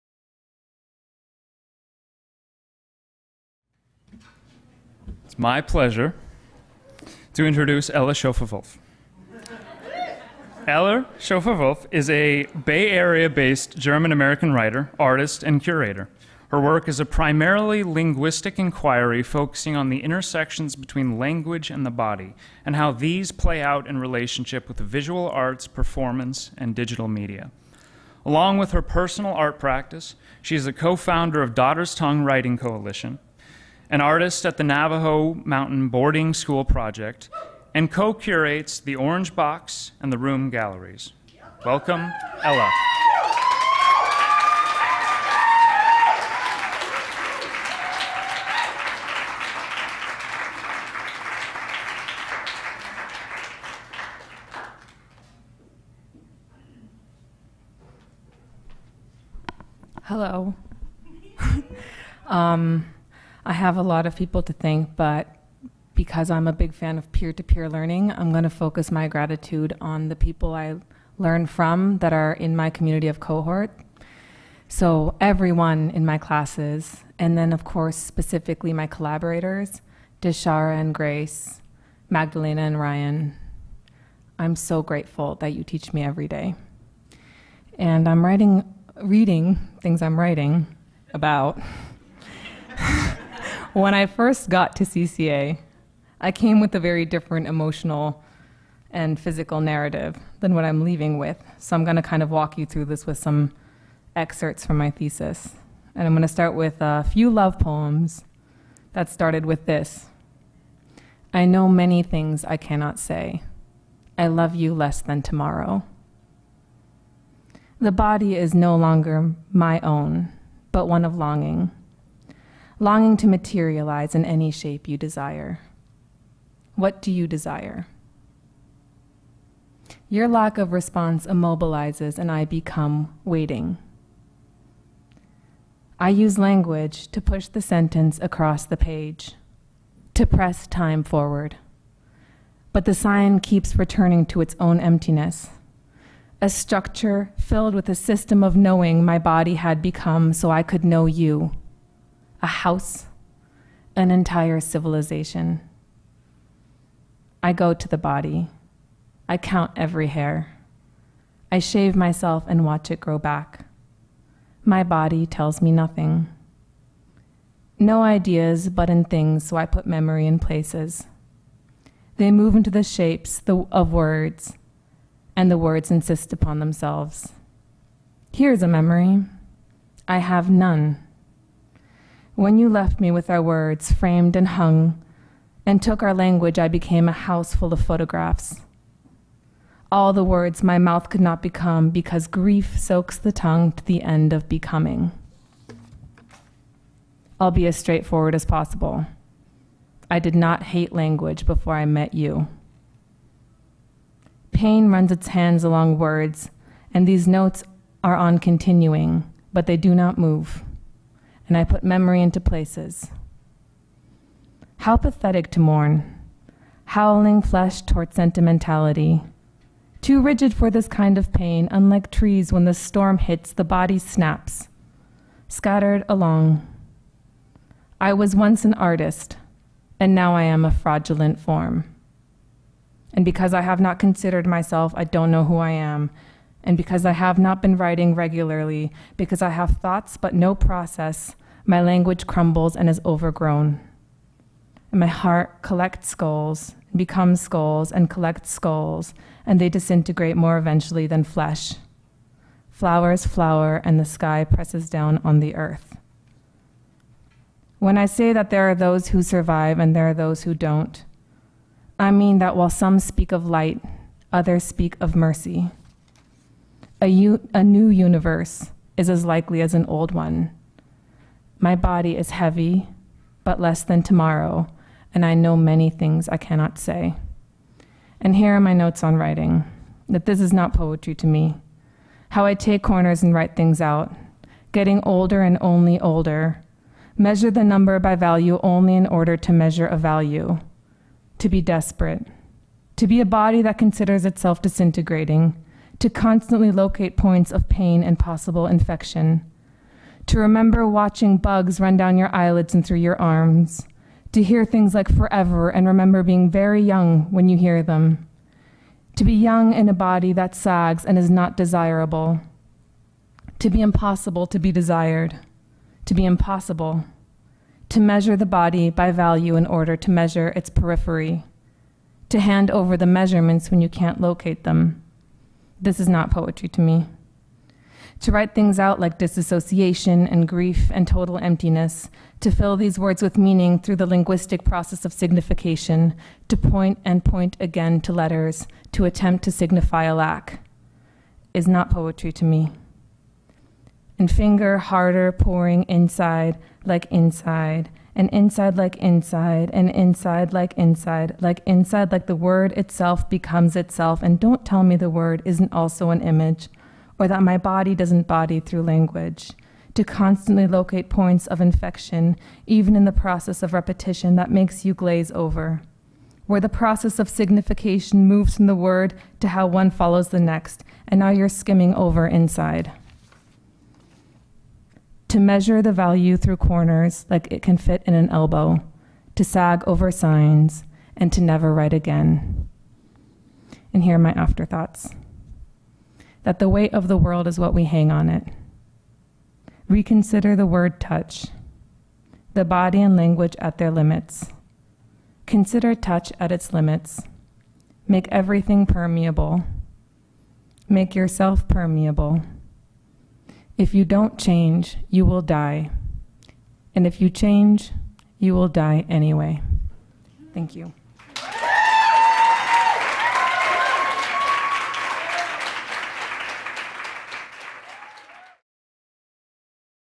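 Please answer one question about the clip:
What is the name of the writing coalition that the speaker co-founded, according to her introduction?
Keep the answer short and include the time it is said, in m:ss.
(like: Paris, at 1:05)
Daughter's Tongue Writing Coalition, at 0:31.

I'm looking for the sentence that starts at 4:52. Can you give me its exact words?
To be a body that considers itself disintegrating.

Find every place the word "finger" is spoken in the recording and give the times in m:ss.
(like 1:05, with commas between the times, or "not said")
5:44.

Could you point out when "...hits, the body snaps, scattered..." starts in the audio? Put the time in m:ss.
3:43.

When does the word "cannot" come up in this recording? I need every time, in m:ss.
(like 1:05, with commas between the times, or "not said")
1:52, 4:36.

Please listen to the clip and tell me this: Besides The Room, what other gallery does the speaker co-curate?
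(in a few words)
Orange Box.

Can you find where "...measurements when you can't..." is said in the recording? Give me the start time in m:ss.
5:23.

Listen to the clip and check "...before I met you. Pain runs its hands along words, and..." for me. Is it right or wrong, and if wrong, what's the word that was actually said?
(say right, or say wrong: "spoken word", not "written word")
right.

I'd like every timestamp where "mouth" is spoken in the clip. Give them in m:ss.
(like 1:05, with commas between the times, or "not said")
3:10.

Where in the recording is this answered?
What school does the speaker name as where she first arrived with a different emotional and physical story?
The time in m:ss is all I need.
1:34.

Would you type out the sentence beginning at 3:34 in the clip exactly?
How pathetic to mourn, howling flesh toward sentimentality.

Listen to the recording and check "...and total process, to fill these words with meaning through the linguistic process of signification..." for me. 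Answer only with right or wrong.
wrong.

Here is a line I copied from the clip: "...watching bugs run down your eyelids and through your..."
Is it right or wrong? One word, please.
right.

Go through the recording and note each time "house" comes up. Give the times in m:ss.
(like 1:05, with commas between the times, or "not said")
2:32, 3:07.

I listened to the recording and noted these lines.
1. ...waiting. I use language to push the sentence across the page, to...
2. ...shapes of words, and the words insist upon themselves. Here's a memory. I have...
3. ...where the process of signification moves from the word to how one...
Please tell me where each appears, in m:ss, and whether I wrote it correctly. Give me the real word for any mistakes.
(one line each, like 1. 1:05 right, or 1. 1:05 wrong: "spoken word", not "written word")
1. 2:13 right
2. 2:52 right
3. 6:06 right.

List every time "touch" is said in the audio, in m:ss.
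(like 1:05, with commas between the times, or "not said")
6:30, 6:35.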